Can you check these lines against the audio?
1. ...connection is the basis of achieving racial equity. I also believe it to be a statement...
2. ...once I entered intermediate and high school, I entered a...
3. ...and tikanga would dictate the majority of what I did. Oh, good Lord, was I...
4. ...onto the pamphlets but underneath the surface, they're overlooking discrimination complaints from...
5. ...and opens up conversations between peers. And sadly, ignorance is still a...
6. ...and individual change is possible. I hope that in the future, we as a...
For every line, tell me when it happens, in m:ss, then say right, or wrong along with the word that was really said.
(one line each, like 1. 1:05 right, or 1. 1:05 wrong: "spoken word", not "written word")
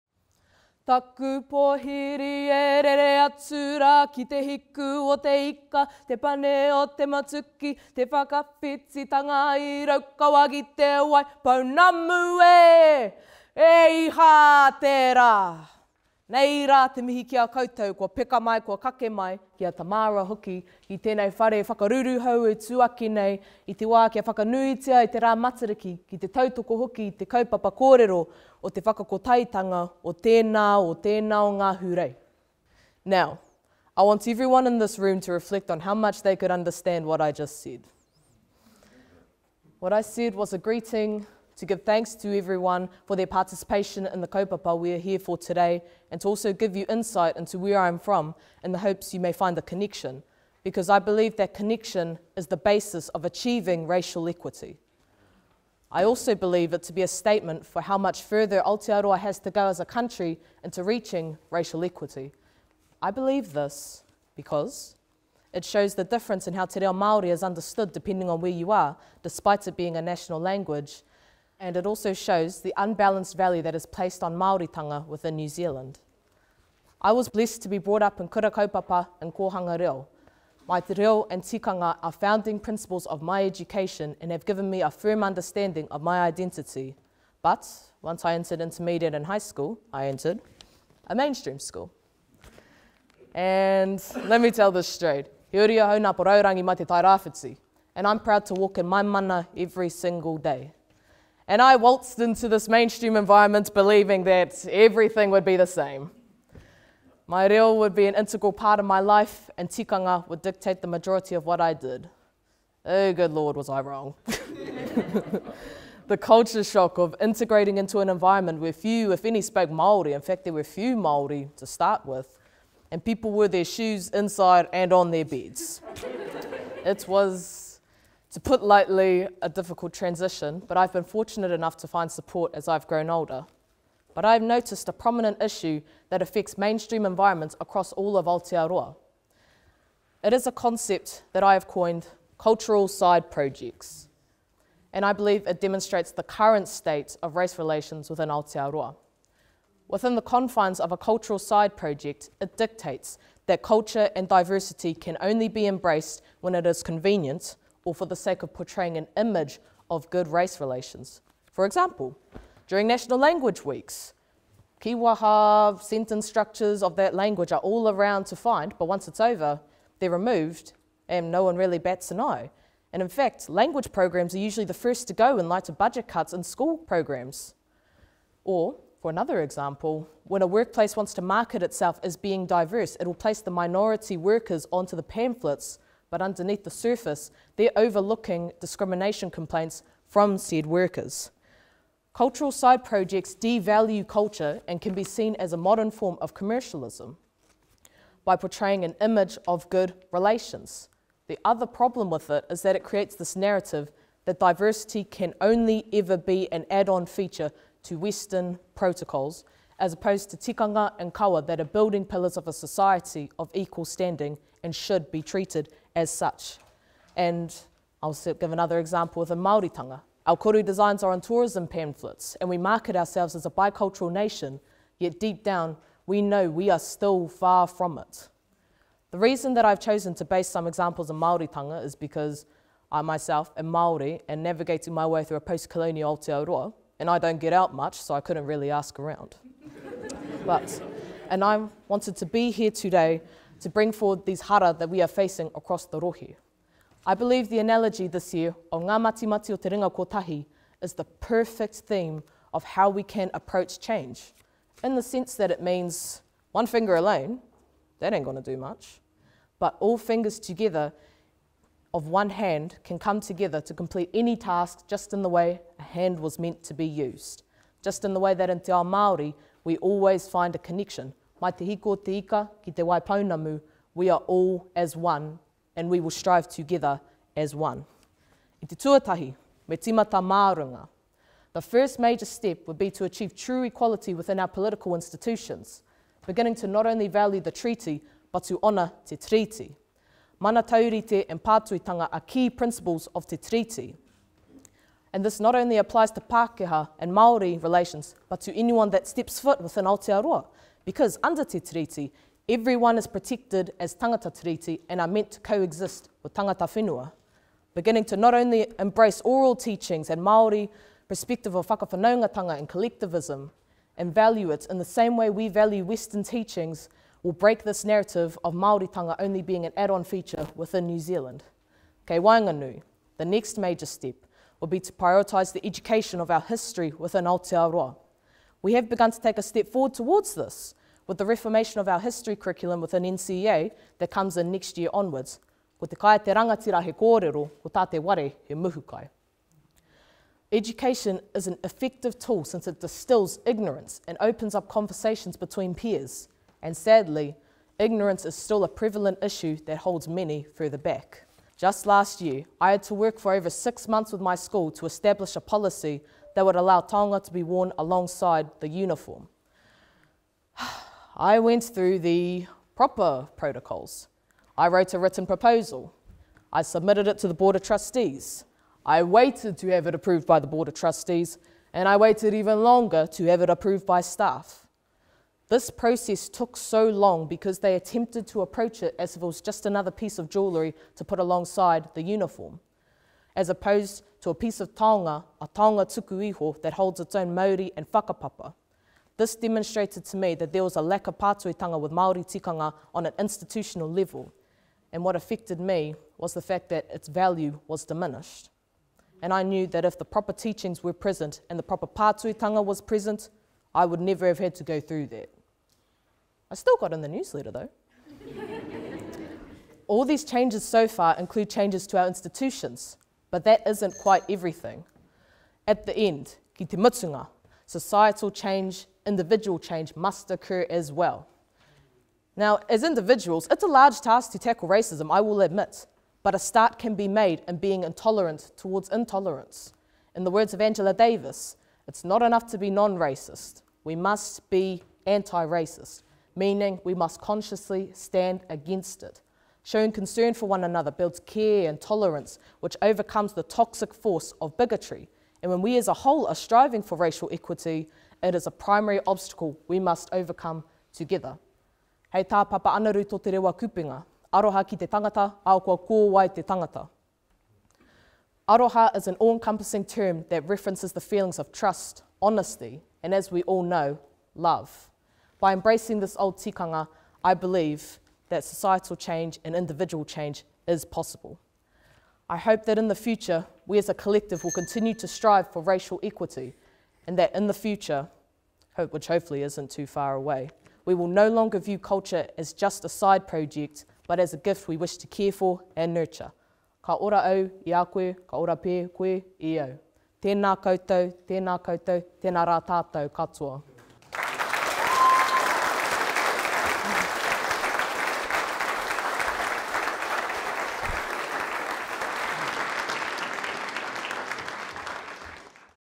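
1. 0:51 right
2. 1:28 right
3. 1:49 right
4. 3:04 right
5. 5:44 right
6. 7:49 right.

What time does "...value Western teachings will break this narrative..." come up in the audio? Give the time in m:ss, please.
5:15.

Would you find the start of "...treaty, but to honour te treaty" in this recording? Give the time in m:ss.
4:47.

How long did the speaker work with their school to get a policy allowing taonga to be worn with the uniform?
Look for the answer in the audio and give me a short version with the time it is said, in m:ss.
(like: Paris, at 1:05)
over 6 months, at 5:53.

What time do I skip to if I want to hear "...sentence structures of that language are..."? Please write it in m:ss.
2:45.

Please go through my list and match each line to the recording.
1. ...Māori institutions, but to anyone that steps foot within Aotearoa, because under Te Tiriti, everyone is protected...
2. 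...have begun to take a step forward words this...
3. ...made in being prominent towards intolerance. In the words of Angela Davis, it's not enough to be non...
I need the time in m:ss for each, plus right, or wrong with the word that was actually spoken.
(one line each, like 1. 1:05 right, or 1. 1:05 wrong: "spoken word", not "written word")
1. 4:57 wrong: "relations", not "institutions"
2. 5:28 wrong: "towards", not "words"
3. 7:07 wrong: "intolerant", not "prominent".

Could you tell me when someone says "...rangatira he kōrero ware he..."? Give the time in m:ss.
5:36.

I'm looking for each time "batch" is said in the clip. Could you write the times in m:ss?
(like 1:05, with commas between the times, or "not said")
not said.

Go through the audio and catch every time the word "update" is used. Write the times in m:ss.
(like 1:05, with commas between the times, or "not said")
not said.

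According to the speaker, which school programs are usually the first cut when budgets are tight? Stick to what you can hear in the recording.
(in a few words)
language programs.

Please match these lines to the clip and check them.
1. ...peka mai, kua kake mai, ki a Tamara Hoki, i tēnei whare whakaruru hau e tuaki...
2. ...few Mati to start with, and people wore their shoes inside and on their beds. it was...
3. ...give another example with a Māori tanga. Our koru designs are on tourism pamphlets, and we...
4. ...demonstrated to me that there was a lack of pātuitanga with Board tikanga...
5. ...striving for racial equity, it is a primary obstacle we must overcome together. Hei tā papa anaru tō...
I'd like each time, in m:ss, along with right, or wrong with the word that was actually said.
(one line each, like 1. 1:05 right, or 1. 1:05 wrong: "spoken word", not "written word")
1. 0:18 right
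2. 2:00 wrong: "Māori", not "Mati"
3. 3:38 right
4. 6:29 wrong: "Māori", not "Board"
5. 7:26 right.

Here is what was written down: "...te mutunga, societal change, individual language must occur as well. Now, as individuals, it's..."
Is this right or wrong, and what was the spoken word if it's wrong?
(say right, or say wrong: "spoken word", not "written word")
wrong: "change", not "language".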